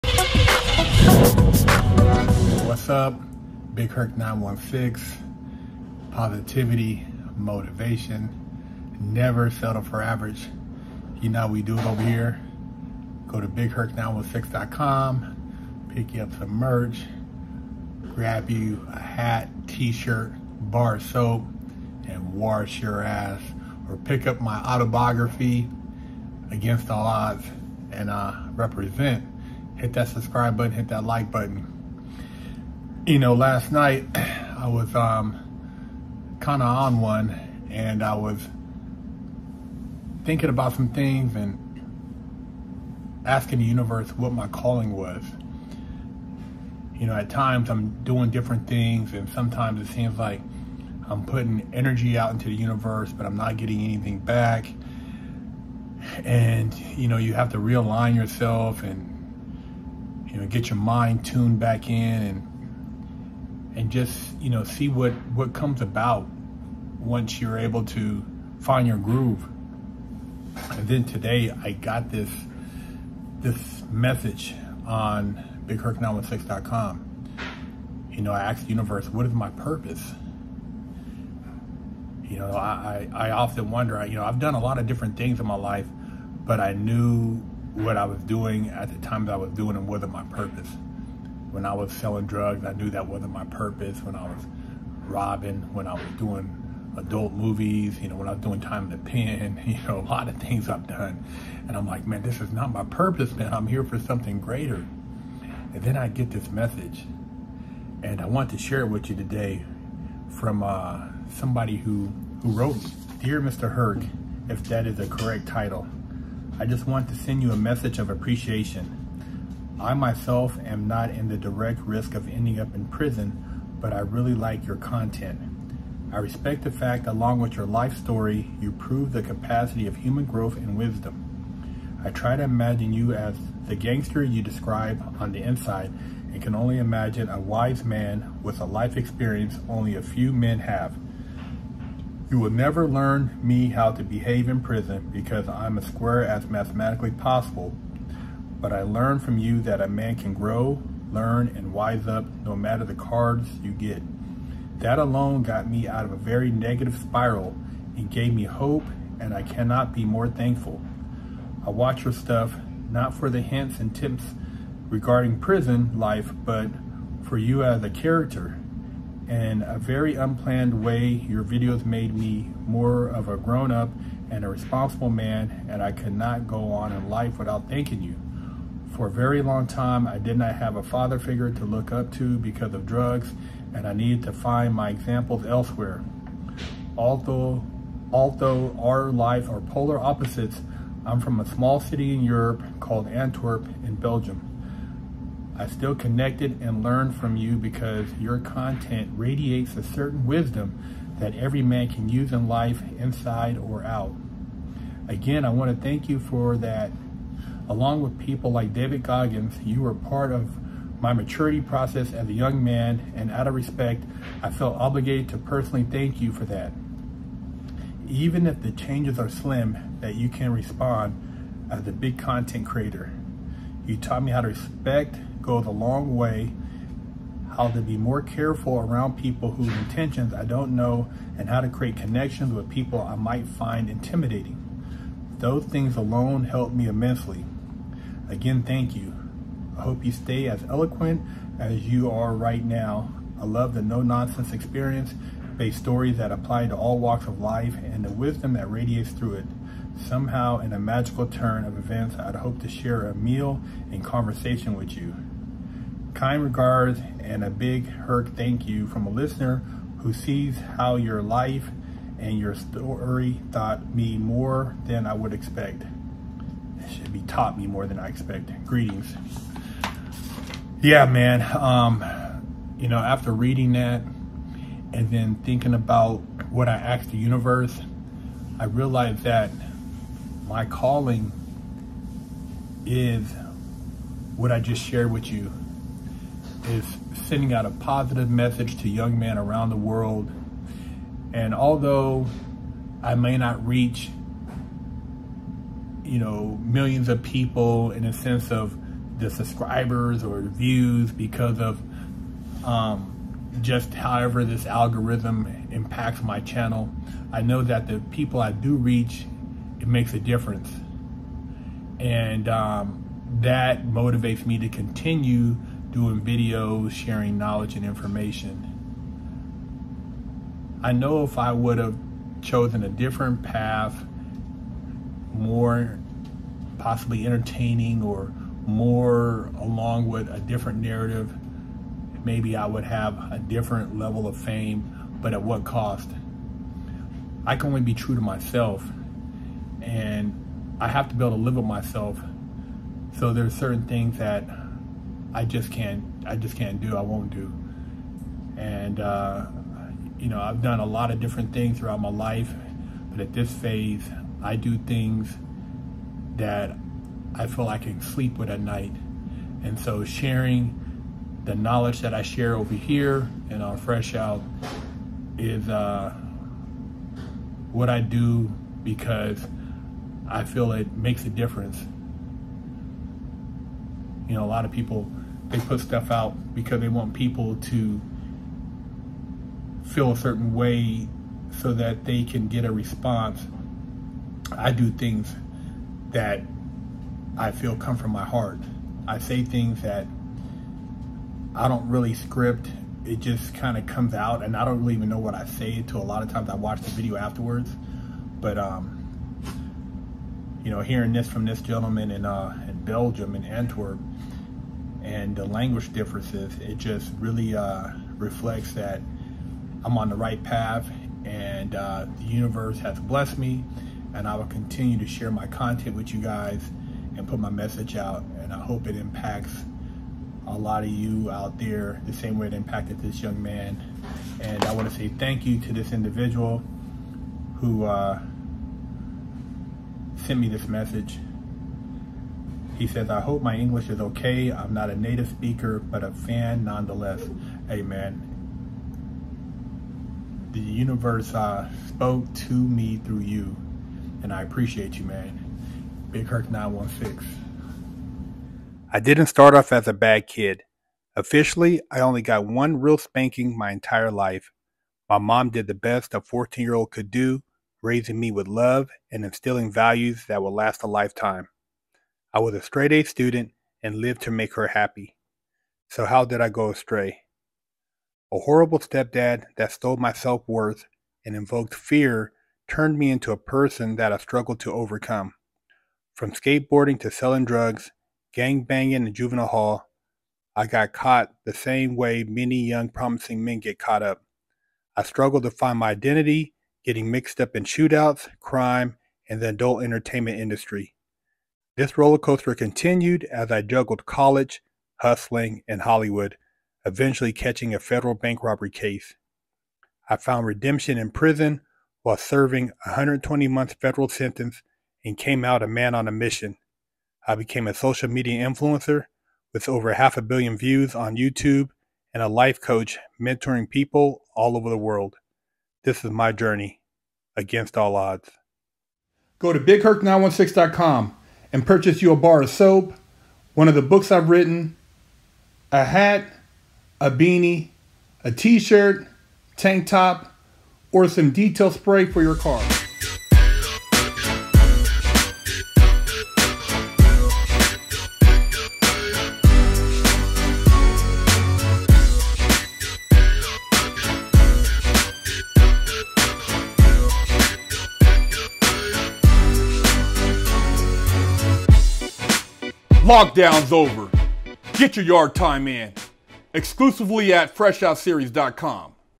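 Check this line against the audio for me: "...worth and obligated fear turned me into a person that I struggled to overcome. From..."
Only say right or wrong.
wrong.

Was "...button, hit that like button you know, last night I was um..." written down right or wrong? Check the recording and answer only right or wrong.
right.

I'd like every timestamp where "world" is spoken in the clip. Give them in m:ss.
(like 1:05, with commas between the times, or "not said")
4:49, 8:34.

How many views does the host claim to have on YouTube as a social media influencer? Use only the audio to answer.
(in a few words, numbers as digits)
Half a billion.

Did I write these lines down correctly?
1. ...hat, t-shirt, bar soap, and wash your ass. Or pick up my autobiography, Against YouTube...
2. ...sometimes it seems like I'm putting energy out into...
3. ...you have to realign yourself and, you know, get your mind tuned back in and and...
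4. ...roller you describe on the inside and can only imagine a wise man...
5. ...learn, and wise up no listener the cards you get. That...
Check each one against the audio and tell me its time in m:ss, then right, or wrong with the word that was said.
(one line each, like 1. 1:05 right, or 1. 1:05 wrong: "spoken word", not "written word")
1. 0:19 wrong: "All", not "YouTube"
2. 0:49 right
3. 0:57 right
4. 2:13 wrong: "gangster", not "roller"
5. 2:31 wrong: "matter", not "listener".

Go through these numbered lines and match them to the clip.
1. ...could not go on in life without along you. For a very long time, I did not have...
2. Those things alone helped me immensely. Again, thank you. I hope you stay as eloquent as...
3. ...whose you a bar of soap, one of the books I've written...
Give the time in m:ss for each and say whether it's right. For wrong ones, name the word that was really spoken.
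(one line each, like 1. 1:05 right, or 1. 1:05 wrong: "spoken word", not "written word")
1. 2:55 wrong: "thanking", not "along"
2. 3:55 right
3. 8:41 wrong: "purchase", not "whose".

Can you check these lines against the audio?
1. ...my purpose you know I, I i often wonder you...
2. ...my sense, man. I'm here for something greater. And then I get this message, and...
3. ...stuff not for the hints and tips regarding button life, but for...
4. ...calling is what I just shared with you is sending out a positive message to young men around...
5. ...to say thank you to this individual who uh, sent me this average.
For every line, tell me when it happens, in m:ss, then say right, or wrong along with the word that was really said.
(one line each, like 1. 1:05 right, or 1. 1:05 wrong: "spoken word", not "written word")
1. 1:19 right
2. 1:42 wrong: "purpose", not "sense"
3. 2:42 wrong: "prison", not "button"
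4. 4:40 right
5. 7:04 wrong: "message", not "average".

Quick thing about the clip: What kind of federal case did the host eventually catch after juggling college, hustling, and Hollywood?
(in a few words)
Bank robbery.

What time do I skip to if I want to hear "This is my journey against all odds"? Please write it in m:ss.
8:35.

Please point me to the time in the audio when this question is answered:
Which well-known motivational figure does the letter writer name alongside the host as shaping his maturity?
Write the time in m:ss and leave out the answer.
3:28.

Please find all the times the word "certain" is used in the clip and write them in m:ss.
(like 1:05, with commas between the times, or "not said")
3:19, 5:43, 6:20.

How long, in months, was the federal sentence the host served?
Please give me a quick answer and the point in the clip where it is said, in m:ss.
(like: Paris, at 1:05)
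120 months, at 8:22.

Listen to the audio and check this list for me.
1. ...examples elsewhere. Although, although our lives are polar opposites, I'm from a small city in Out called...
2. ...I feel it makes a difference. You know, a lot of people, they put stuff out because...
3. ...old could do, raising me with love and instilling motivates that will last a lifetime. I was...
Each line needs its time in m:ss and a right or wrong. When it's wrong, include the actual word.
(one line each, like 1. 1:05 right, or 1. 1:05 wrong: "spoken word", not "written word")
1. 3:04 wrong: "Europe", not "Out"
2. 6:10 right
3. 7:36 wrong: "values", not "motivates".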